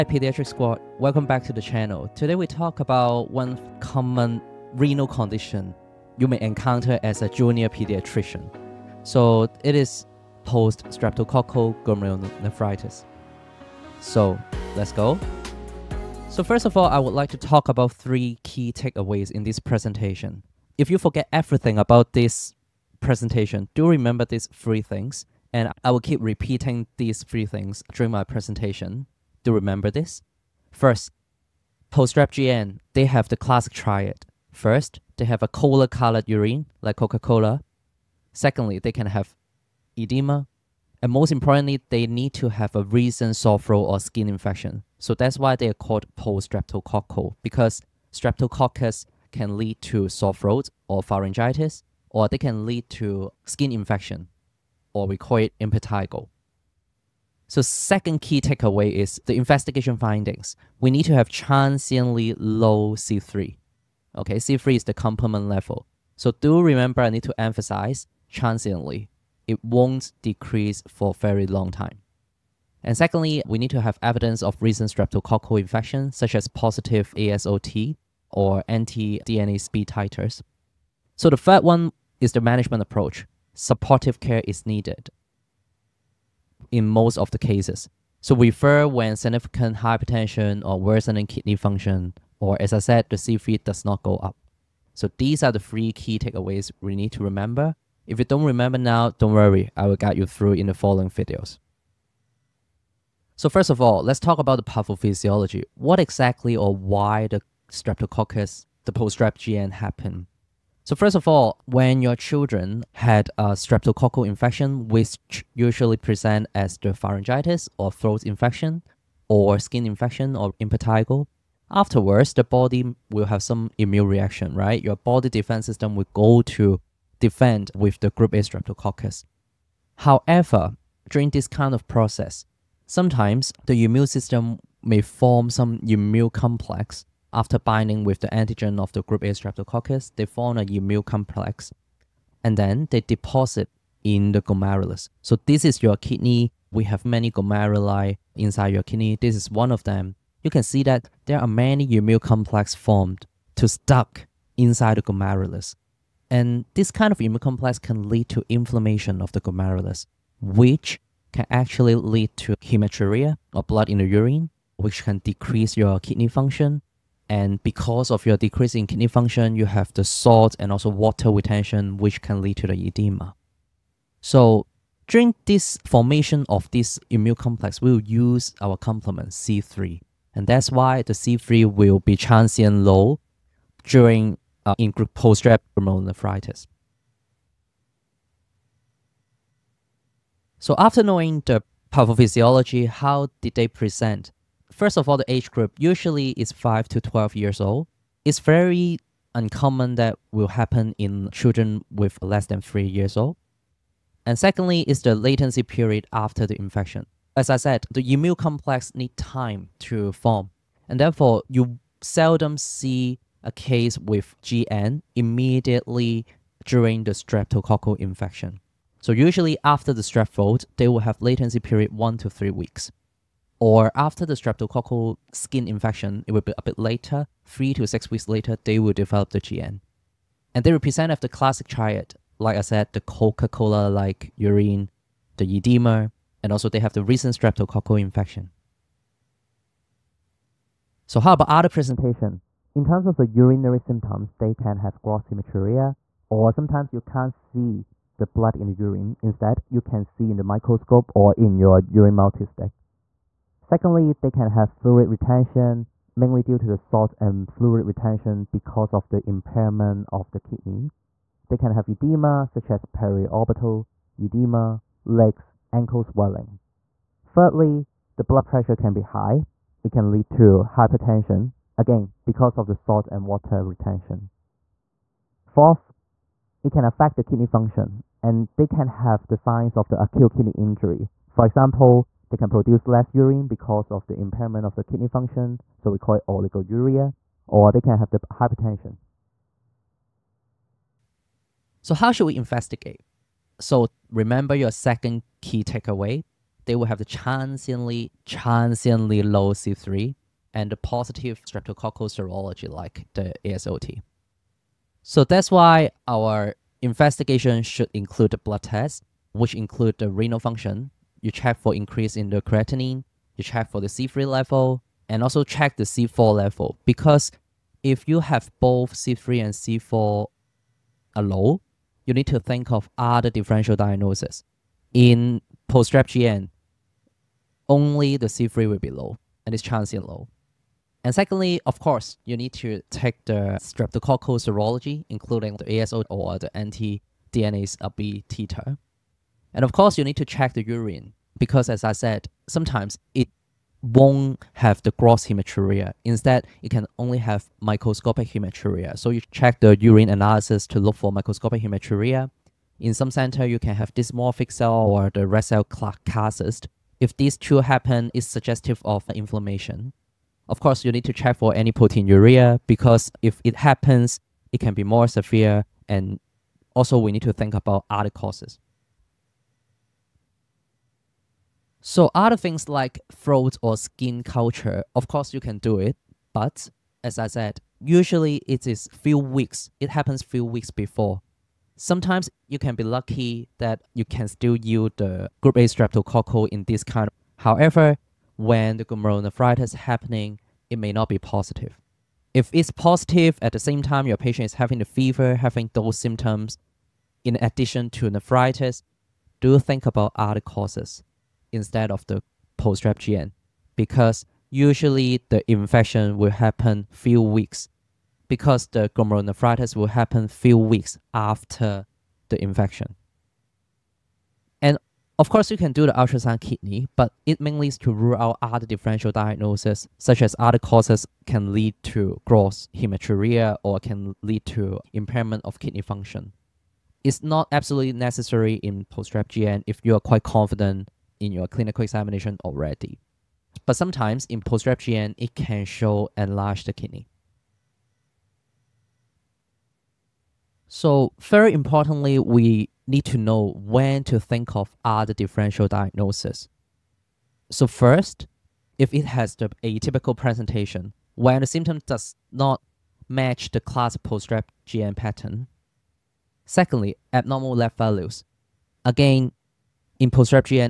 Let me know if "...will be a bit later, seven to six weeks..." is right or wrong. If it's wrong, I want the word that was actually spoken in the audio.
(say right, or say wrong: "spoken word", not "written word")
wrong: "three", not "seven".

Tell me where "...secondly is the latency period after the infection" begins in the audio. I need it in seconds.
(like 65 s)
204 s.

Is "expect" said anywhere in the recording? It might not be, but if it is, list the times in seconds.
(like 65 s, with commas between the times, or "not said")
not said.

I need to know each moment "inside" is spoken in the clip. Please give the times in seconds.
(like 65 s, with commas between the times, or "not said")
148 s, 154 s.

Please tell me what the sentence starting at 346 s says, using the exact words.
Instead, it can only have microscopic hematuria.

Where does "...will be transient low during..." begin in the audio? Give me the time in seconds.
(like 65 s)
181 s.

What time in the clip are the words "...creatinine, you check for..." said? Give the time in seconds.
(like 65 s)
312 s.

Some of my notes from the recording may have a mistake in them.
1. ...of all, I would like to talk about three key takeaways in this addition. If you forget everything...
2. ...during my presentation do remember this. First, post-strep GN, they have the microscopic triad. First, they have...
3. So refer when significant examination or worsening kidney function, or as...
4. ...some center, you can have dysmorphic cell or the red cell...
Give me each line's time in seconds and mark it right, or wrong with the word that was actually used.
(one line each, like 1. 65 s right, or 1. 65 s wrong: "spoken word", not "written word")
1. 16 s wrong: "presentation", not "addition"
2. 27 s wrong: "classic", not "microscopic"
3. 88 s wrong: "hypertension", not "examination"
4. 352 s right.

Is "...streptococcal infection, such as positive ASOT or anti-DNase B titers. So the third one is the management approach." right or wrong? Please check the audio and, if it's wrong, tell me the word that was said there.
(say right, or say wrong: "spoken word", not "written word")
right.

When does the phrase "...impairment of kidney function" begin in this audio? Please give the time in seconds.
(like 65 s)
424 s.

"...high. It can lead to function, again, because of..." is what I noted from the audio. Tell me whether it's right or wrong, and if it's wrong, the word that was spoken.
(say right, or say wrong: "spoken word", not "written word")
wrong: "hypertension", not "function".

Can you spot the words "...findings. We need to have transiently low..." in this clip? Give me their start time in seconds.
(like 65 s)
59 s.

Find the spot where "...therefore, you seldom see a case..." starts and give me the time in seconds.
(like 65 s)
210 s.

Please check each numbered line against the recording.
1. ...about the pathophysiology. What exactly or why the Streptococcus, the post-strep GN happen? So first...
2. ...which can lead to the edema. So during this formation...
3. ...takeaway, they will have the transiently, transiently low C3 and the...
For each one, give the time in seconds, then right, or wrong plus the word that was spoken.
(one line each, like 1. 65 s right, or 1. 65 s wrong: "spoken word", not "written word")
1. 104 s right
2. 171 s right
3. 295 s right.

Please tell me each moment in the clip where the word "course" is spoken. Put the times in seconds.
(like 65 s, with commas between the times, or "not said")
331 s, 339 s, 360 s, 375 s, 415 s.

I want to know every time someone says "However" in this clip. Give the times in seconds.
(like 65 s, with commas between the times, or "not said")
129 s, 387 s.